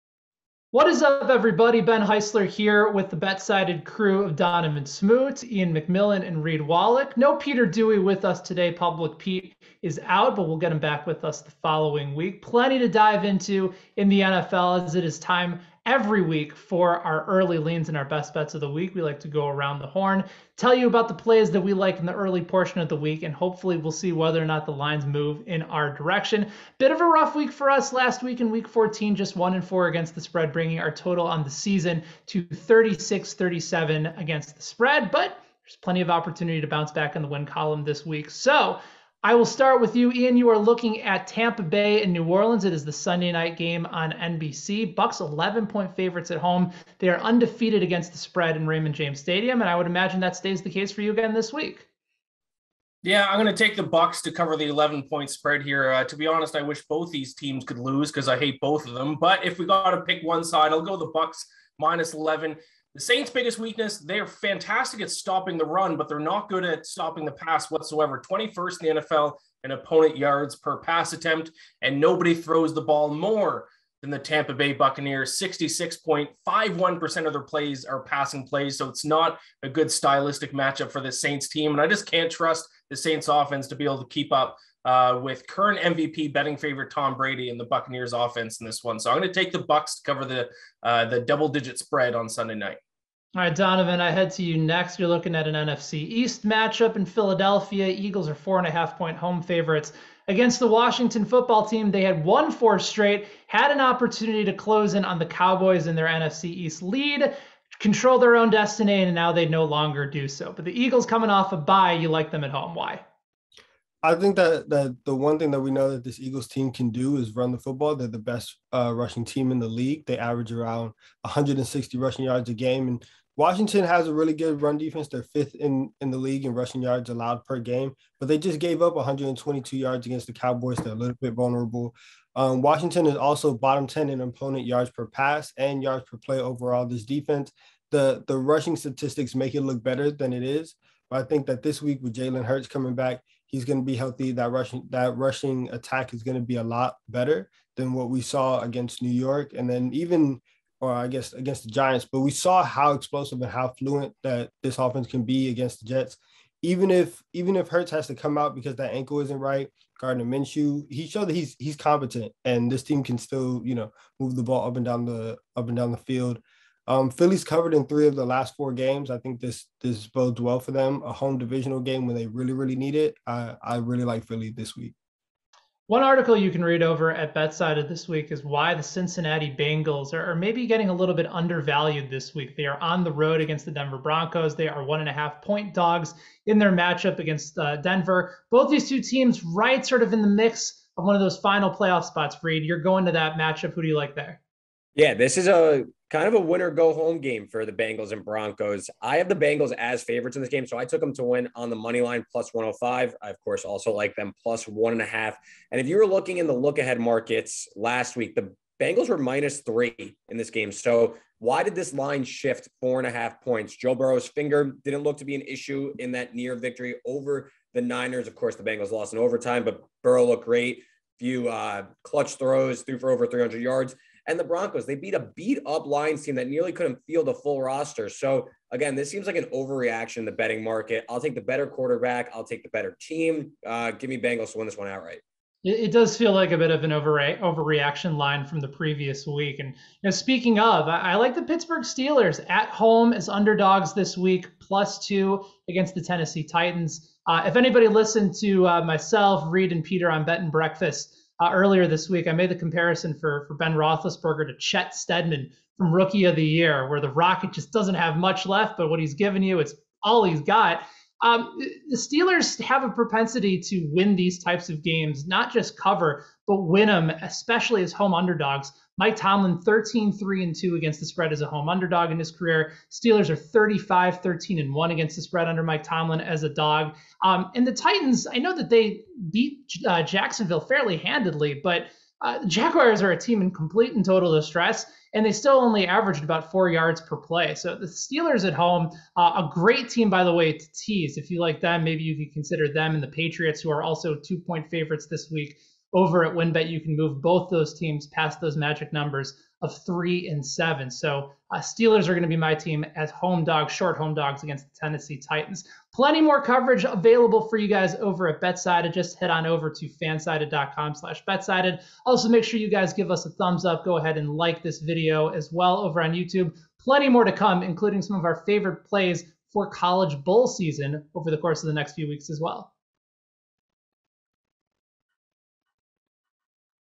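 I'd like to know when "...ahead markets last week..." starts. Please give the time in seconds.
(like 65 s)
206 s.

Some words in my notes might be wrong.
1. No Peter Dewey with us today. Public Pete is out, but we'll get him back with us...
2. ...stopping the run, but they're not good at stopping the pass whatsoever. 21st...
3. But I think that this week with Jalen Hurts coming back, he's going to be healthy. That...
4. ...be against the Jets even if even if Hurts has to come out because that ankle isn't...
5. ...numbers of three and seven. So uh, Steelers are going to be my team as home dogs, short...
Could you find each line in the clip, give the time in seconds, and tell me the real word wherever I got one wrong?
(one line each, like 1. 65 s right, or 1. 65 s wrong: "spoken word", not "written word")
1. 7 s right
2. 65 s right
3. 141 s right
4. 155 s right
5. 298 s right.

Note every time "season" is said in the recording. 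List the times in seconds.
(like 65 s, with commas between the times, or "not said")
31 s, 320 s.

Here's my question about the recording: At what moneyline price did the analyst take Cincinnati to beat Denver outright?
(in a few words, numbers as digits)
+105.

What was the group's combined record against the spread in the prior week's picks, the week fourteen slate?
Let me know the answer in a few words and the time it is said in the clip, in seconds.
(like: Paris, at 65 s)
1-4, at 29 s.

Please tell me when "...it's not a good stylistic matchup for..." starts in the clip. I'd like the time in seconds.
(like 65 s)
78 s.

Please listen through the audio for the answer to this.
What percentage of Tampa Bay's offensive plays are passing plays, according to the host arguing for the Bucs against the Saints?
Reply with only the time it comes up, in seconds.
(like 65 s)
75 s.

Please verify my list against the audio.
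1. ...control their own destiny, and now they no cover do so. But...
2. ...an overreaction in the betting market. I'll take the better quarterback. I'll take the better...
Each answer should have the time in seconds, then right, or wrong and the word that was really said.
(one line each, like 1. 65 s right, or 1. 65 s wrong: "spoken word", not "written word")
1. 107 s wrong: "longer", not "cover"
2. 229 s right.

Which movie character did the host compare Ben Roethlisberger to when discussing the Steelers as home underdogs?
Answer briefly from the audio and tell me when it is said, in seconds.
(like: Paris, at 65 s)
Chet Steadman, at 254 s.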